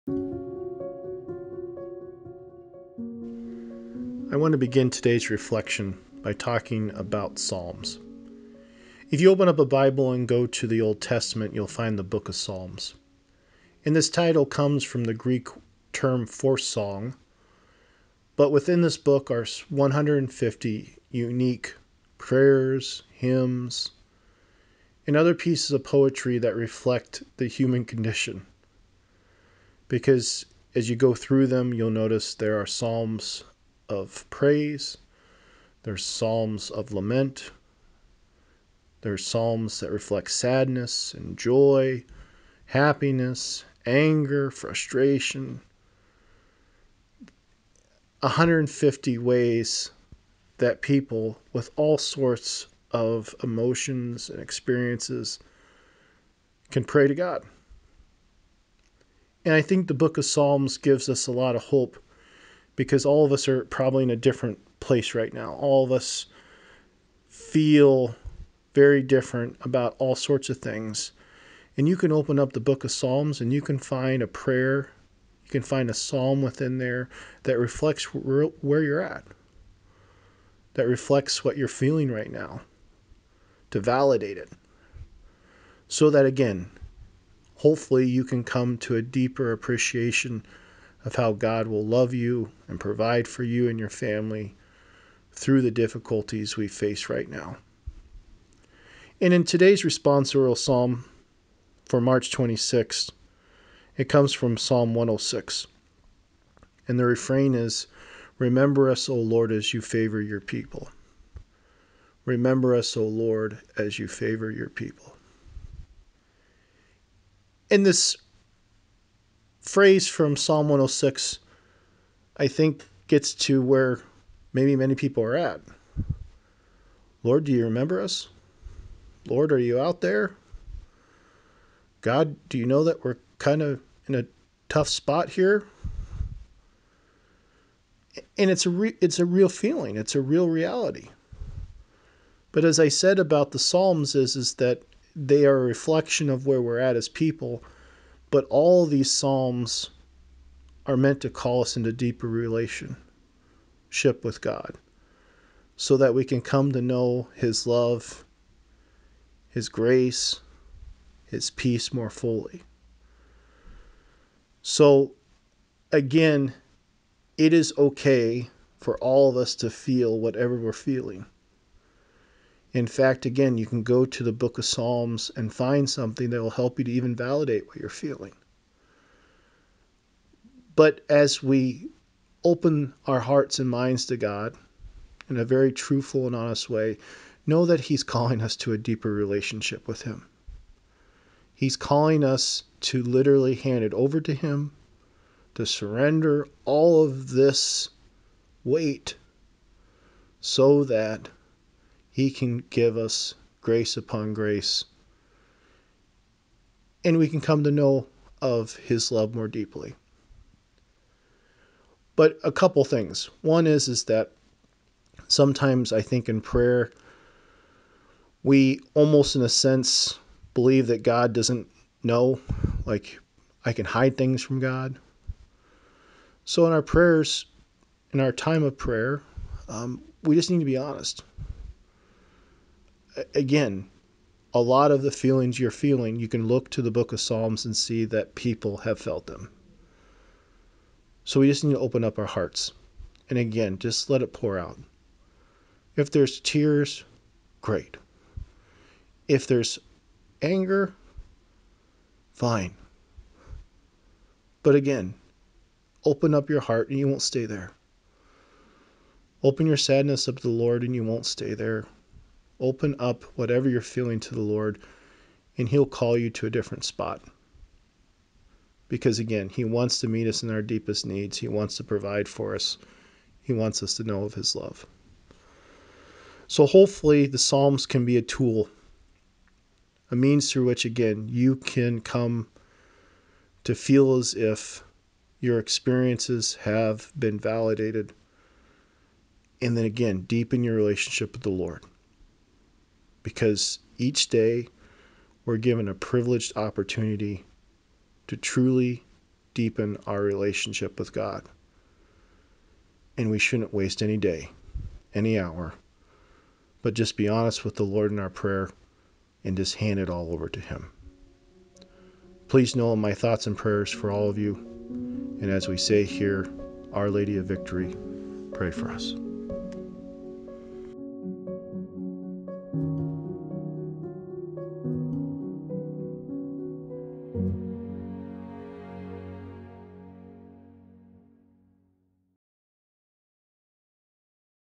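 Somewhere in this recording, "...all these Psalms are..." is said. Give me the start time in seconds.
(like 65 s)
148 s.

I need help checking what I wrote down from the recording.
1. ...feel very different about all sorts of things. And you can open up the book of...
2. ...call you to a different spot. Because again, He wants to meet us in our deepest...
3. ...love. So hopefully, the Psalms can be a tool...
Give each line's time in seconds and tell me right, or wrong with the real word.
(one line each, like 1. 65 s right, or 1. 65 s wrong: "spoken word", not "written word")
1. 67 s right
2. 265 s right
3. 274 s right.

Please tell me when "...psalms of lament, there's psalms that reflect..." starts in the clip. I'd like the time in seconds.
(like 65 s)
36 s.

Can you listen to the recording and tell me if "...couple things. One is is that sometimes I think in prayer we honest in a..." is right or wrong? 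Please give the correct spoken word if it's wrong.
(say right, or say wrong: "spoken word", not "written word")
wrong: "almost", not "honest".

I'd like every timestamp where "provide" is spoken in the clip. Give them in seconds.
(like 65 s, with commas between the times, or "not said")
92 s, 271 s.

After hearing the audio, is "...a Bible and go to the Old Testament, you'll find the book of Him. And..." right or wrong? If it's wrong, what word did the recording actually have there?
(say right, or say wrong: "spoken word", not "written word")
wrong: "Psalms", not "Him".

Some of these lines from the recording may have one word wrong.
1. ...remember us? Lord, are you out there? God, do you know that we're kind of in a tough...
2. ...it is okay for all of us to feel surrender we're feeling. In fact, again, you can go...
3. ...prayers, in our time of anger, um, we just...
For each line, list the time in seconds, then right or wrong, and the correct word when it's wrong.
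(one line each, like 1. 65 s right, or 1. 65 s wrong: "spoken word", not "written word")
1. 127 s right
2. 167 s wrong: "whatever", not "surrender"
3. 226 s wrong: "prayer", not "anger".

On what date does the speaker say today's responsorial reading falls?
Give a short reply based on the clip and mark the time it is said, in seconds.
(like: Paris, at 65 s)
March 26, at 102 s.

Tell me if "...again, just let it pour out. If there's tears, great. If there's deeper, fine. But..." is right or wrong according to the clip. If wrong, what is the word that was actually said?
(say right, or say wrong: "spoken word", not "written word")
wrong: "anger", not "deeper".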